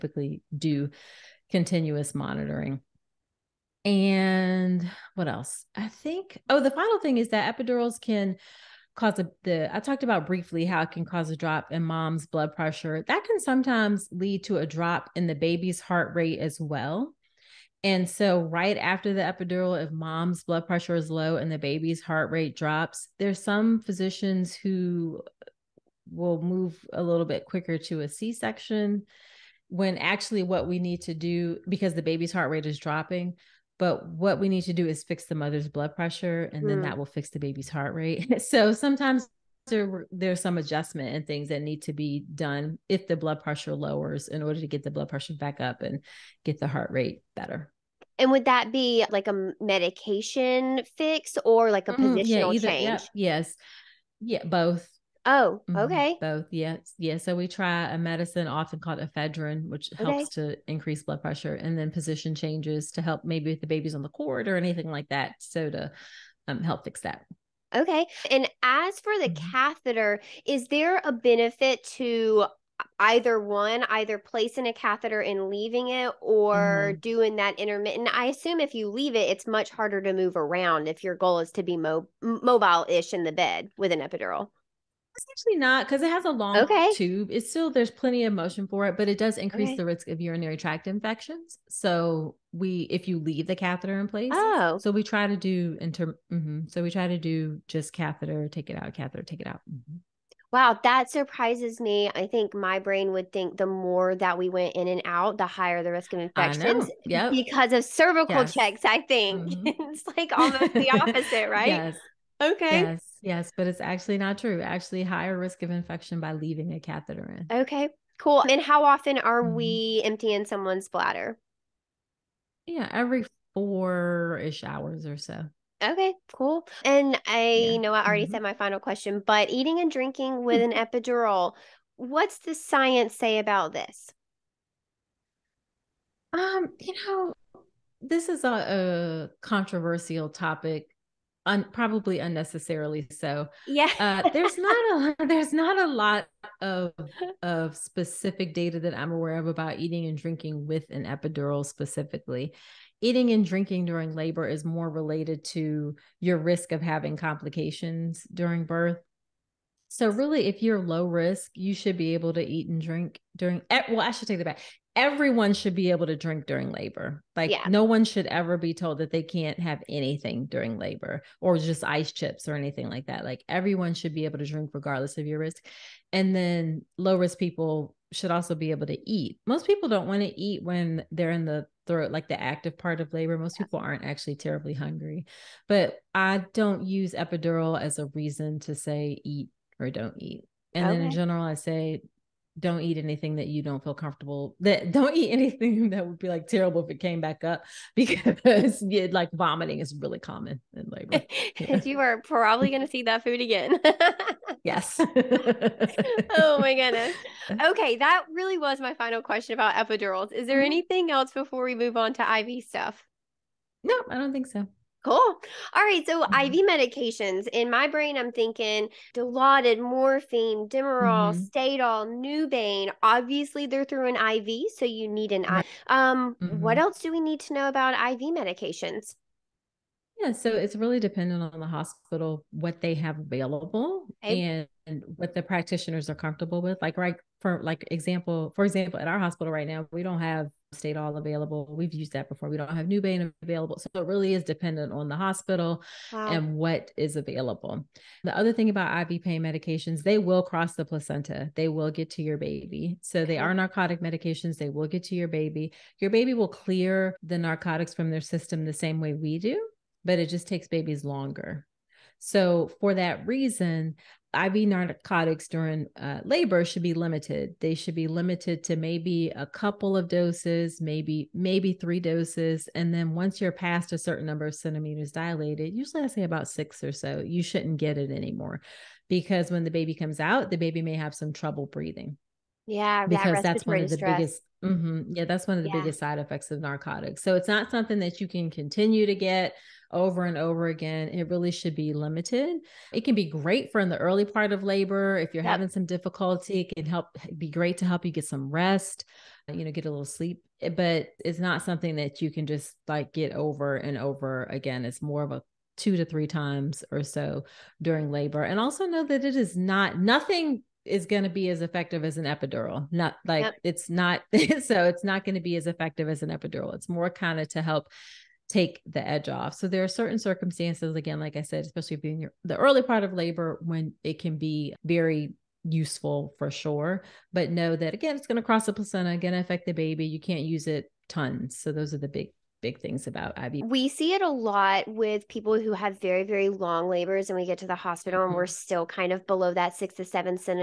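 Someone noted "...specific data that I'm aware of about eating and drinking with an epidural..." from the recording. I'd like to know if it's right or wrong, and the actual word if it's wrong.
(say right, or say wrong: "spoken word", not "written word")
right.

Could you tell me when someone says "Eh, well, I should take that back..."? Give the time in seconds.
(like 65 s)
163 s.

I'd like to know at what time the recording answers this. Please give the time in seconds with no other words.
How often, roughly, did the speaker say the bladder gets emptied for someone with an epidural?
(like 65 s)
122 s.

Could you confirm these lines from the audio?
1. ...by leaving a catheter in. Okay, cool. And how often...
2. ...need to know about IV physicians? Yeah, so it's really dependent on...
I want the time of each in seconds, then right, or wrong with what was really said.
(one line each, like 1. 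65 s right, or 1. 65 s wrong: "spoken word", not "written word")
1. 116 s right
2. 227 s wrong: "medications", not "physicians".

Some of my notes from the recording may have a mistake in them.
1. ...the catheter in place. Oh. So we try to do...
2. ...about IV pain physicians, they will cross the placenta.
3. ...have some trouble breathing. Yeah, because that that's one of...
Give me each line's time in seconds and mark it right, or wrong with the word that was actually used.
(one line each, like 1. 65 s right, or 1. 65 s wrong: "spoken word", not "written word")
1. 93 s right
2. 248 s wrong: "medications", not "physicians"
3. 280 s right.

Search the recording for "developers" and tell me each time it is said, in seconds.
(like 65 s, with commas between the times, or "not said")
not said.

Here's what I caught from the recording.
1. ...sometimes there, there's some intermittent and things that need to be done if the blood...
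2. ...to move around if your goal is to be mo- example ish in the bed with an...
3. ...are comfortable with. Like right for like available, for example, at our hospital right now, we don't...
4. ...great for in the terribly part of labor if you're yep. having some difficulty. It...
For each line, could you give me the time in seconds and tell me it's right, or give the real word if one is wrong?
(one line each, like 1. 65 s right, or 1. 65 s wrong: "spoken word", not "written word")
1. 38 s wrong: "adjustment", not "intermittent"
2. 80 s wrong: "mobile", not "example"
3. 236 s wrong: "example", not "available"
4. 293 s wrong: "early", not "terribly".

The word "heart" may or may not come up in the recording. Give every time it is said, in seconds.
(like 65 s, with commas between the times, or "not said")
15 s, 22 s, 32 s, 37 s, 46 s.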